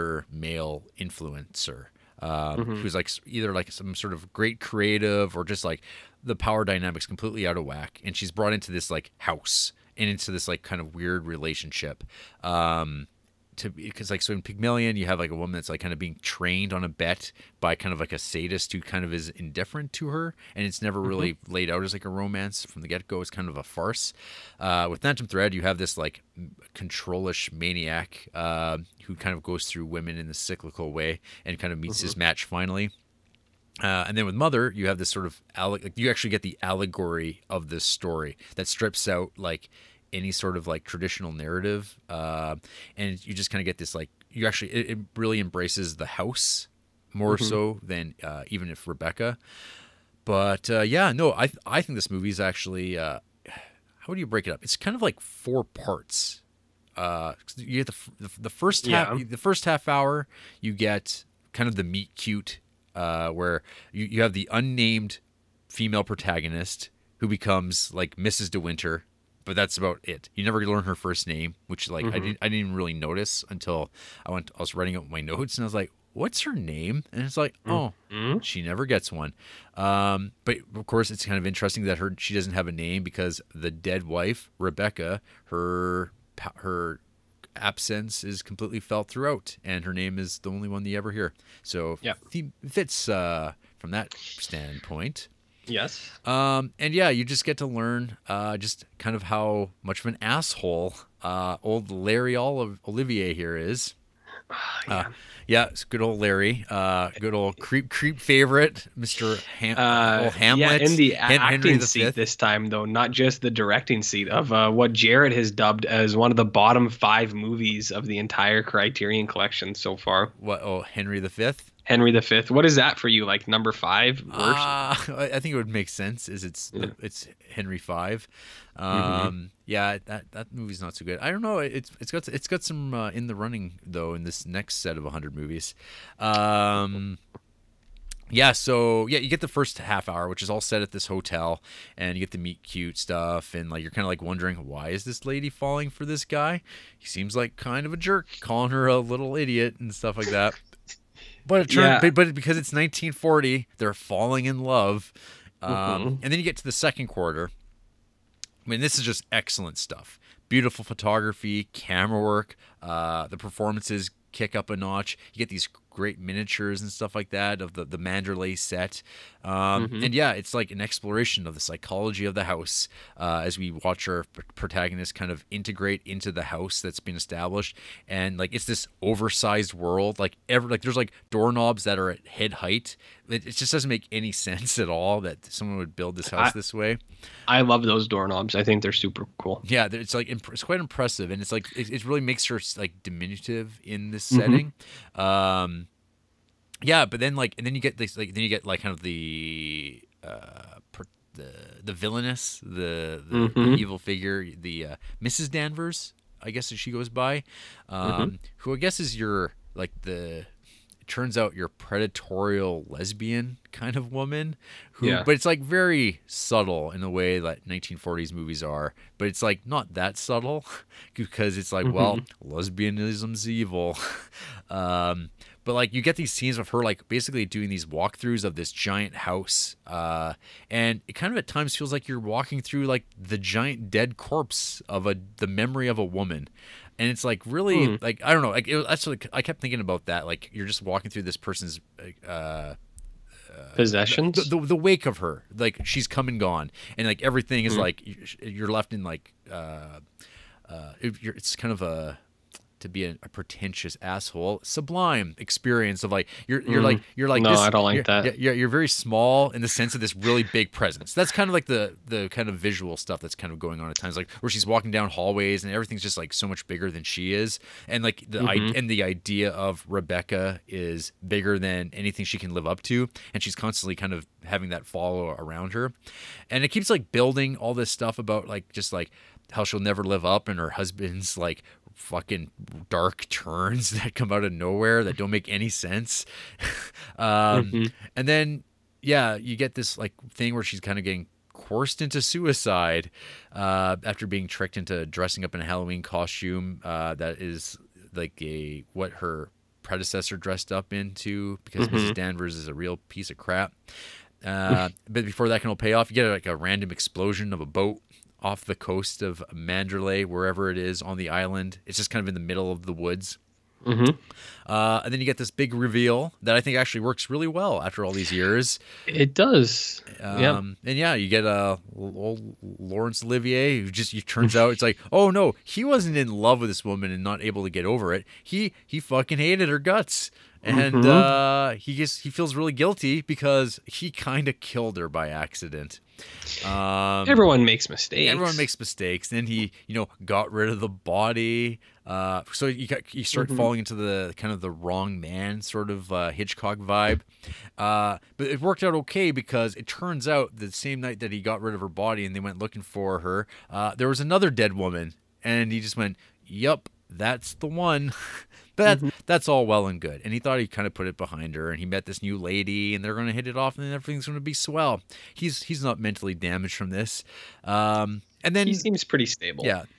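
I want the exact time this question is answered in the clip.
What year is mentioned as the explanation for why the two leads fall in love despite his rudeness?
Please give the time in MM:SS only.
02:32.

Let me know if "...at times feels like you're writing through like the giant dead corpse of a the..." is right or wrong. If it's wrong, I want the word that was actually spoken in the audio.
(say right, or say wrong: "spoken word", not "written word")
wrong: "walking", not "writing".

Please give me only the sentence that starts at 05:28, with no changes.
He he fucking hated her guts and mm-hmm.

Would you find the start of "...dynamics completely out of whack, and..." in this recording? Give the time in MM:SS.
00:06.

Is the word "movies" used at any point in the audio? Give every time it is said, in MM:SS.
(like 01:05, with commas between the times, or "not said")
00:52, 01:57, 02:10, 02:15, 03:38.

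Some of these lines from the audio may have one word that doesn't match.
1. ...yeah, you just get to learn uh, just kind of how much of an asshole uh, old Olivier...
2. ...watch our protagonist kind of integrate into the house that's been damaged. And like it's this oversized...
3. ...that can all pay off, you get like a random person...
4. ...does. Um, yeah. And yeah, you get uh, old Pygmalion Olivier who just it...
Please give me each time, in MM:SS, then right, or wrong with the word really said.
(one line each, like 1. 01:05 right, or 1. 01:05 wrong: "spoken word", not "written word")
1. 01:36 wrong: "Larry", not "Olivier"
2. 02:53 wrong: "established", not "damaged"
3. 05:05 wrong: "explosion", not "person"
4. 05:19 wrong: "Laurence", not "Pygmalion".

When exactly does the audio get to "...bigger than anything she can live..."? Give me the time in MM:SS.
04:31.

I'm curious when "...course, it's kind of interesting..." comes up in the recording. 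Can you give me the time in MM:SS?
01:20.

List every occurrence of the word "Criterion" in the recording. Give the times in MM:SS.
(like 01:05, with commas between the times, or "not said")
01:58.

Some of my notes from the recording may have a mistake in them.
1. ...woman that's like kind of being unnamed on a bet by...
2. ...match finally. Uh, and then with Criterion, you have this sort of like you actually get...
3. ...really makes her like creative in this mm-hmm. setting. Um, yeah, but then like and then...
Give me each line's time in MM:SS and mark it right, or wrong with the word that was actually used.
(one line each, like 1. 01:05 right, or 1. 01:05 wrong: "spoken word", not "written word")
1. 00:15 wrong: "trained", not "unnamed"
2. 00:32 wrong: "Mother", not "Criterion"
3. 03:12 wrong: "diminutive", not "creative".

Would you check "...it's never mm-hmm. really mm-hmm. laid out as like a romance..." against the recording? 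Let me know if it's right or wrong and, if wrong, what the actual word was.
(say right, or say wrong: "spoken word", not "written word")
right.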